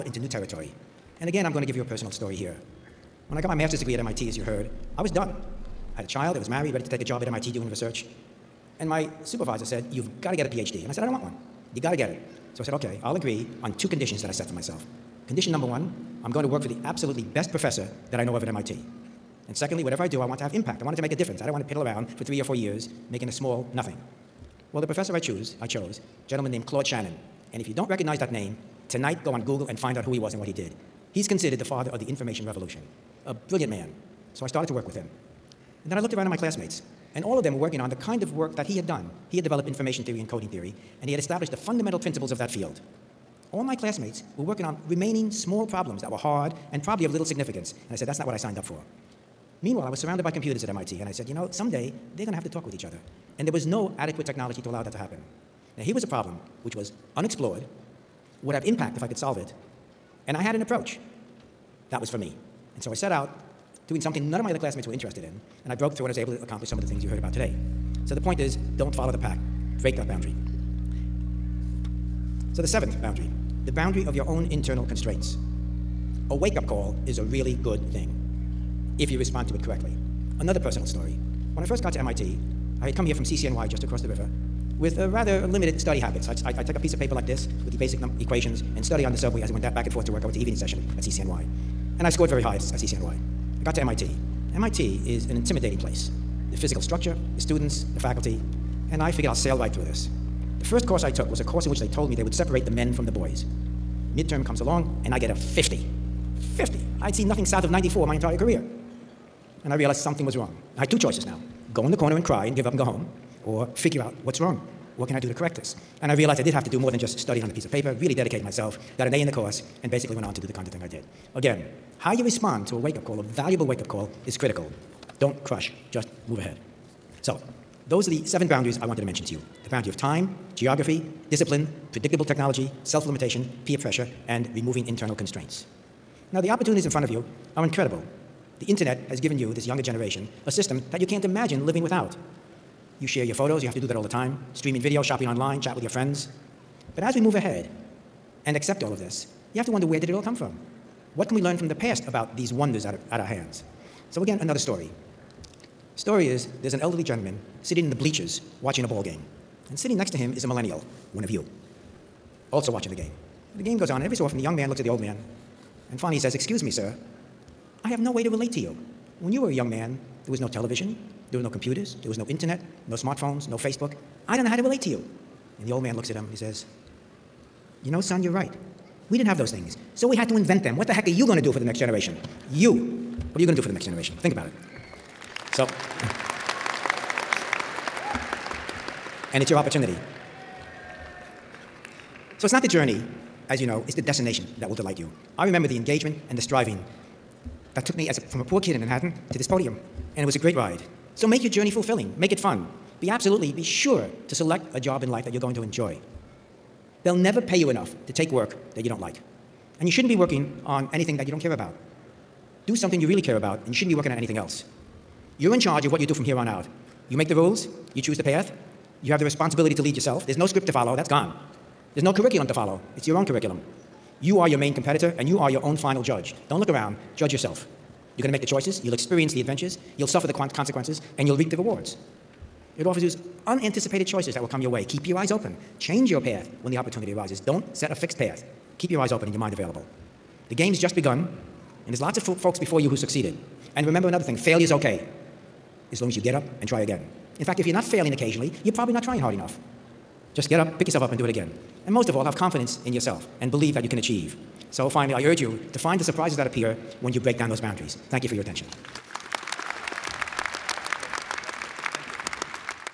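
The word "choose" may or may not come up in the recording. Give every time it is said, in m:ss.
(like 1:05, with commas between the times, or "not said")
0:25, 3:38.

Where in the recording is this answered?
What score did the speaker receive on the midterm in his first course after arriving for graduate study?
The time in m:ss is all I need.
1:45.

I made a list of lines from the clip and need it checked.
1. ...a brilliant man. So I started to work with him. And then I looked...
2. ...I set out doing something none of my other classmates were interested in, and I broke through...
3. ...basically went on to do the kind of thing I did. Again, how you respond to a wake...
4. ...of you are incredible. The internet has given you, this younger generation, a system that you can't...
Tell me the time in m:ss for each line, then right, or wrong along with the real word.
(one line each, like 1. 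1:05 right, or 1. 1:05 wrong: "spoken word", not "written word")
1. 0:33 right
2. 1:02 right
3. 1:59 right
4. 2:17 right.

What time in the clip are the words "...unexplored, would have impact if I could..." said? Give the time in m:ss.
0:57.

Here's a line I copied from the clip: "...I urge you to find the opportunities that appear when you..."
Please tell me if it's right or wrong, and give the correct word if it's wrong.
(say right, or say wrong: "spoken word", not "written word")
wrong: "surprises", not "opportunities".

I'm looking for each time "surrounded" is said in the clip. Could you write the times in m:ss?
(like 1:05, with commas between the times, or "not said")
0:49.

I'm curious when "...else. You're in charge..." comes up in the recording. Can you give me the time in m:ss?
3:34.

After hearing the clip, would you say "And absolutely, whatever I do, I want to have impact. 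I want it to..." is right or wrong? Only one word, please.
wrong.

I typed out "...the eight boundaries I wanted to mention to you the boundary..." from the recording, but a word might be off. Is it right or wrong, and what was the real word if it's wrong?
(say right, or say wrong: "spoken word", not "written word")
wrong: "seven", not "eight".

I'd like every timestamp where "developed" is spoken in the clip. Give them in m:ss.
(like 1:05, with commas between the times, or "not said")
0:39.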